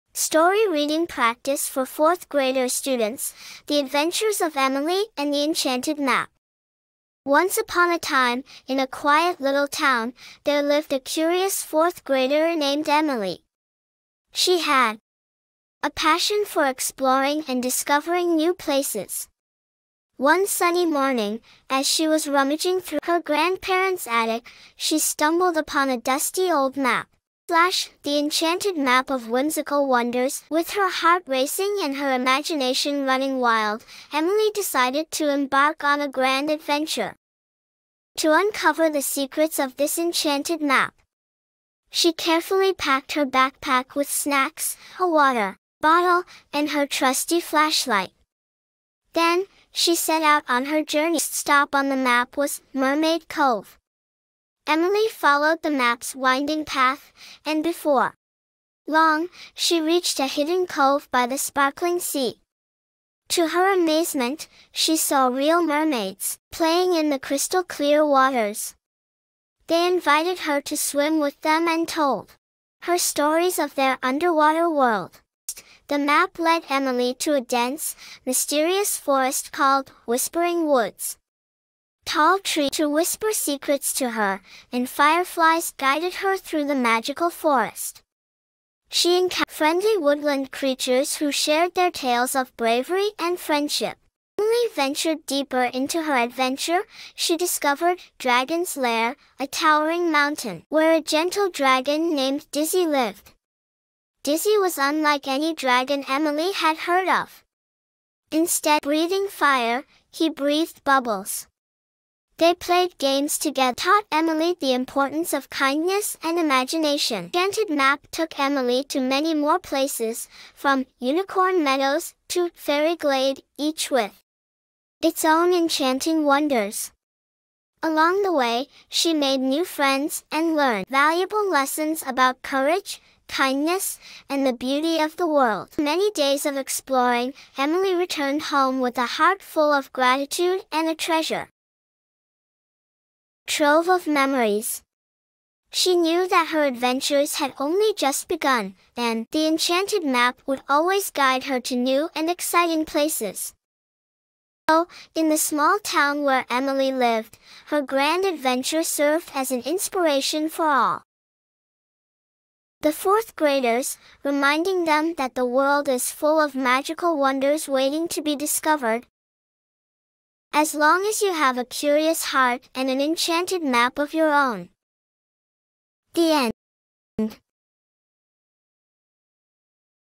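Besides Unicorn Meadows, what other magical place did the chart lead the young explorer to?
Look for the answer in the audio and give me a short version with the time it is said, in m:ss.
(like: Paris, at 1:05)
Fairy Glade, at 2:02.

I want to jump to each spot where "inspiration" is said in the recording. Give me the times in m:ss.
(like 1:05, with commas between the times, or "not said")
2:39.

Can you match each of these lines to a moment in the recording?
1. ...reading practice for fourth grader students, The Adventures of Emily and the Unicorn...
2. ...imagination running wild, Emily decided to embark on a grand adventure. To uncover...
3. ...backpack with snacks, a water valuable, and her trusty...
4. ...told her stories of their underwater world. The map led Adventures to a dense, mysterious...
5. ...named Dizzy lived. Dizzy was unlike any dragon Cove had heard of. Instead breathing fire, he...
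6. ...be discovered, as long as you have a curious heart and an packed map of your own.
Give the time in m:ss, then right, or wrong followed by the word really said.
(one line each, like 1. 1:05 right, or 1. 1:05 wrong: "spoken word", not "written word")
1. 0:00 wrong: "Enchanted", not "Unicorn"
2. 0:32 right
3. 0:43 wrong: "bottle", not "valuable"
4. 1:11 wrong: "Emily", not "Adventures"
5. 1:42 wrong: "Emily", not "Cove"
6. 2:48 wrong: "enchanted", not "packed".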